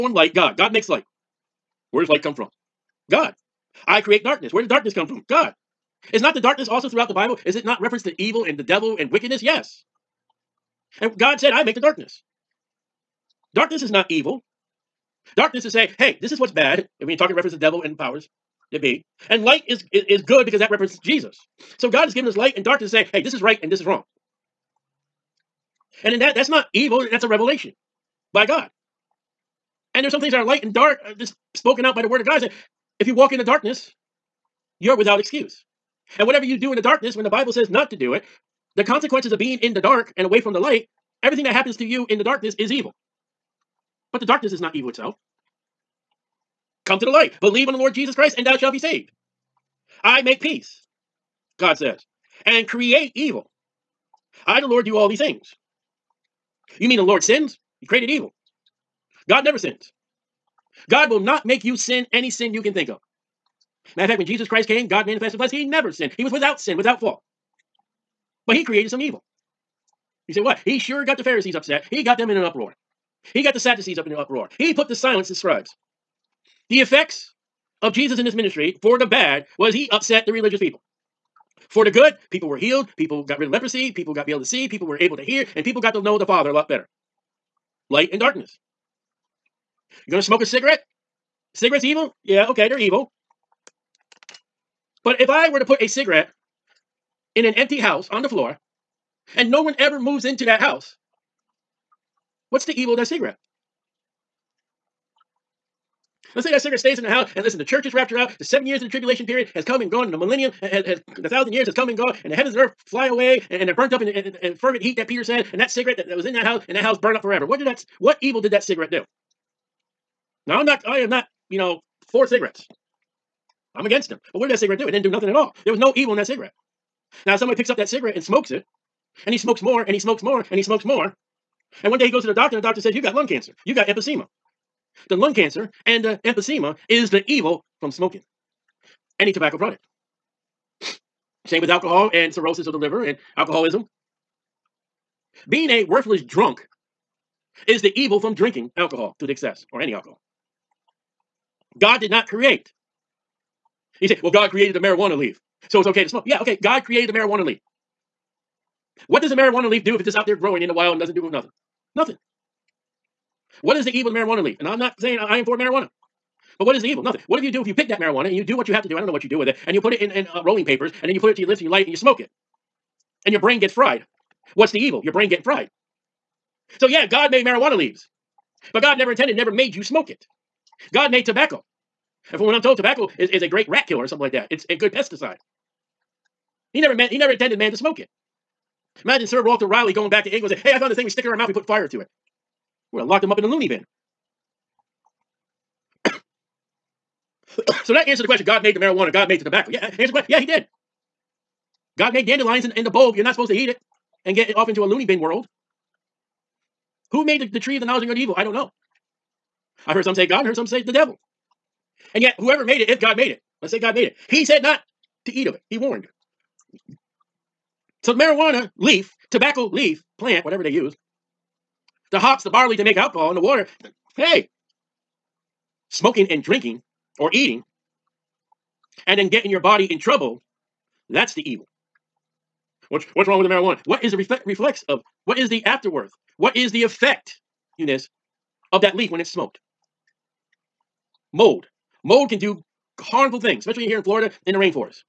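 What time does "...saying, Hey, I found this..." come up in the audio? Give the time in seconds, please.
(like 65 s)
190 s.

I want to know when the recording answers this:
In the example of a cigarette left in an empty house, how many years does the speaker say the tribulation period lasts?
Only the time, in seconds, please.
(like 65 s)
108 s.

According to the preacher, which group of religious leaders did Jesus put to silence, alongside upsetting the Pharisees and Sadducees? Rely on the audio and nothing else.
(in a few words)
the scribes.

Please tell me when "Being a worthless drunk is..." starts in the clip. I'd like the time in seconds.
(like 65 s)
145 s.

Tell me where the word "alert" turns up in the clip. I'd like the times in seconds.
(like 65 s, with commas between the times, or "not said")
not said.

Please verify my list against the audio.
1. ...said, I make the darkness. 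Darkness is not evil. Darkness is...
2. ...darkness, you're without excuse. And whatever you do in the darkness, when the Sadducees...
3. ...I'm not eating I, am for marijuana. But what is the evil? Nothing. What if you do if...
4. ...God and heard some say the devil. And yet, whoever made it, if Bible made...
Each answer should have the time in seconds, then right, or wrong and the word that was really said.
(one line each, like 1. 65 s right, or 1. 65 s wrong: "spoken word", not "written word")
1. 11 s right
2. 33 s wrong: "Bible", not "Sadducees"
3. 164 s wrong: "saying", not "eating"
4. 210 s wrong: "God", not "Bible".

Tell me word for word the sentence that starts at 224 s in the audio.
Hey, smoking and drinking or eating and then getting your body in trouble, that's the evil.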